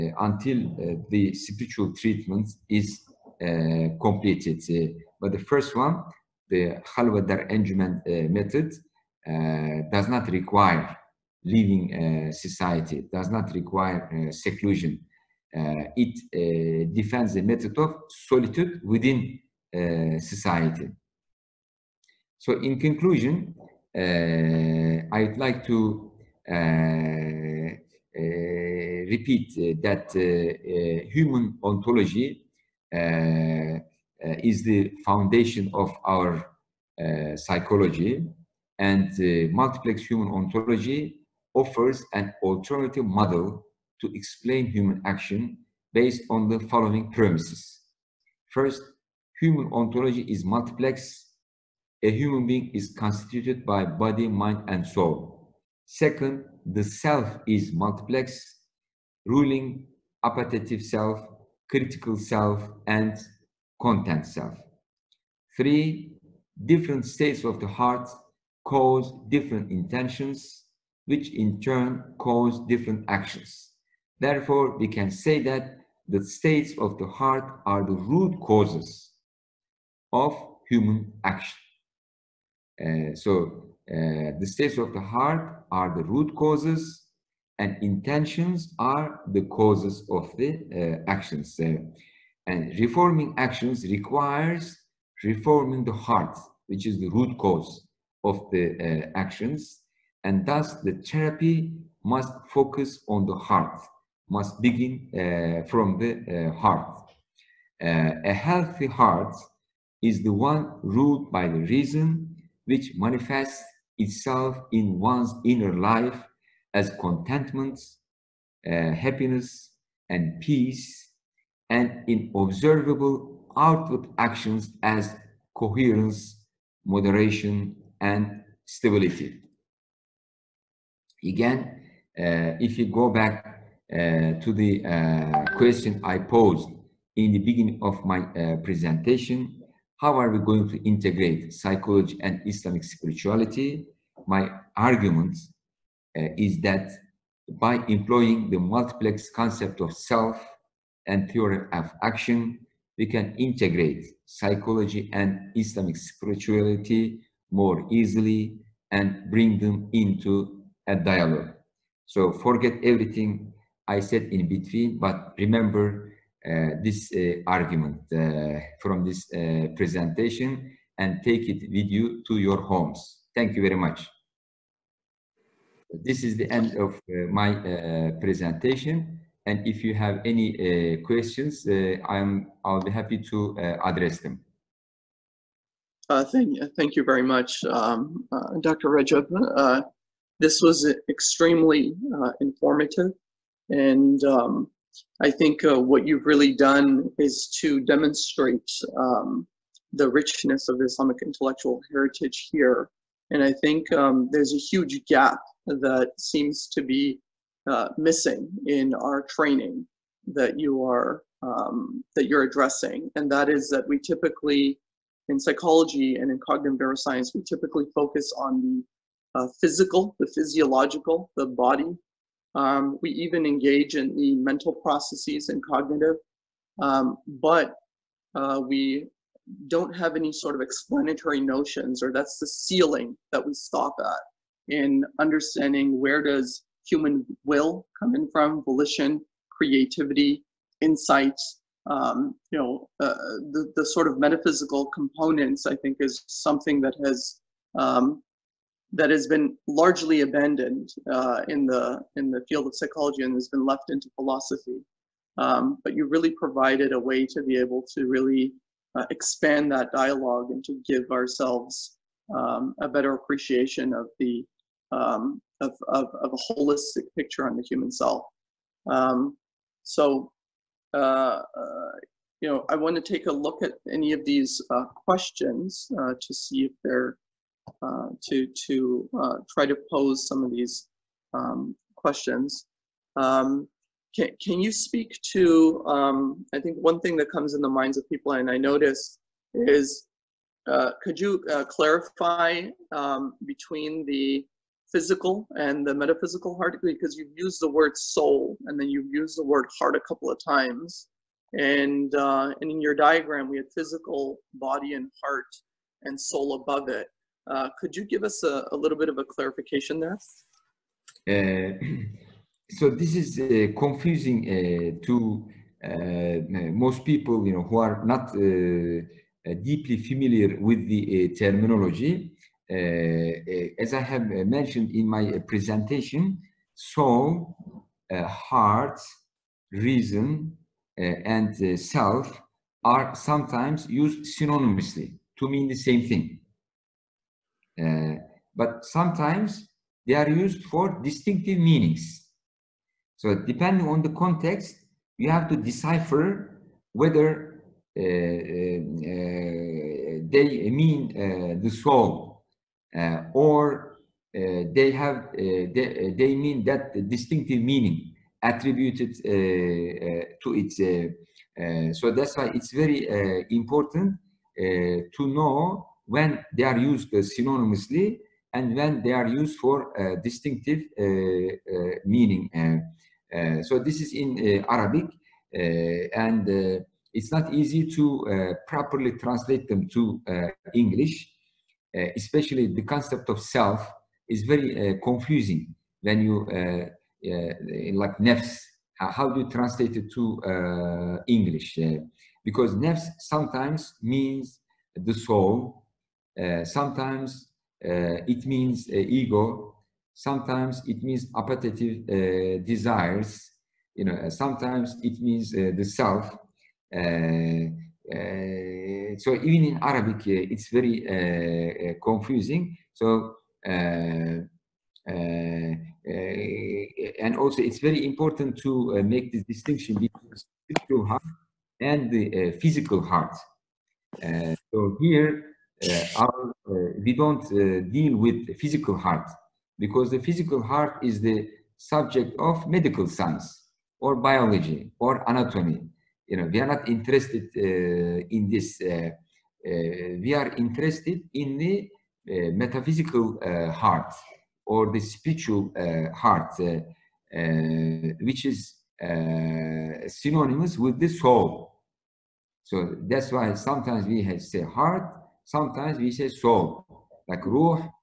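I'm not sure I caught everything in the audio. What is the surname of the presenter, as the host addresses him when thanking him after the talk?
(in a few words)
Rajab.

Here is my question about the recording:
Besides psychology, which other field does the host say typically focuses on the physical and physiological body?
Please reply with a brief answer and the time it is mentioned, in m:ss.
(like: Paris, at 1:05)
cognitive neuroscience, at 3:36.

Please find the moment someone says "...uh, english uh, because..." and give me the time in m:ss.
6:30.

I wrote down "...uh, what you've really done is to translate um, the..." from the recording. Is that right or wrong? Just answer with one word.
wrong.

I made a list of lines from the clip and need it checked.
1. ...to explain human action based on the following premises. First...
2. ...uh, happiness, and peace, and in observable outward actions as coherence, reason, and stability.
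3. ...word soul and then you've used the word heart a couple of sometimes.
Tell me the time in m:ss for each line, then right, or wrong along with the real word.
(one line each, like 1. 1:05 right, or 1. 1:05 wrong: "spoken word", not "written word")
1. 0:44 right
2. 1:58 wrong: "moderation", not "reason"
3. 4:57 wrong: "times", not "sometimes".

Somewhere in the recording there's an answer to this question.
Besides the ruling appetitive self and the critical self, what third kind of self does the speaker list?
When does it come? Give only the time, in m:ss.
1:03.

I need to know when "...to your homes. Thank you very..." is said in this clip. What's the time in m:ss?
2:52.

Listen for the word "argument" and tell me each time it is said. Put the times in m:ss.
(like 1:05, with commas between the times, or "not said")
2:24, 2:47.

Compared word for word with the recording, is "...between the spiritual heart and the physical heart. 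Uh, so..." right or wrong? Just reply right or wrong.
right.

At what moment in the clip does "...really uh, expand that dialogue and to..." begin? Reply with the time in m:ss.
4:18.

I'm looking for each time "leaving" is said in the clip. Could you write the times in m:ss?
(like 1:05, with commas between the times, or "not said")
0:11.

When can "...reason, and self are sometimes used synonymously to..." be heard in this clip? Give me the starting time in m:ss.
5:29.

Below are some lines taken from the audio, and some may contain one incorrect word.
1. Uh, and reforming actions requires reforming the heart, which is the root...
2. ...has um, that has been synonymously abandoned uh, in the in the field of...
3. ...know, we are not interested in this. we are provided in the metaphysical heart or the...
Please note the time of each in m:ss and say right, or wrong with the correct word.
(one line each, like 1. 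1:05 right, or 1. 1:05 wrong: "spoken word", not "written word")
1. 1:31 right
2. 4:07 wrong: "largely", not "synonymously"
3. 7:16 wrong: "interested", not "provided".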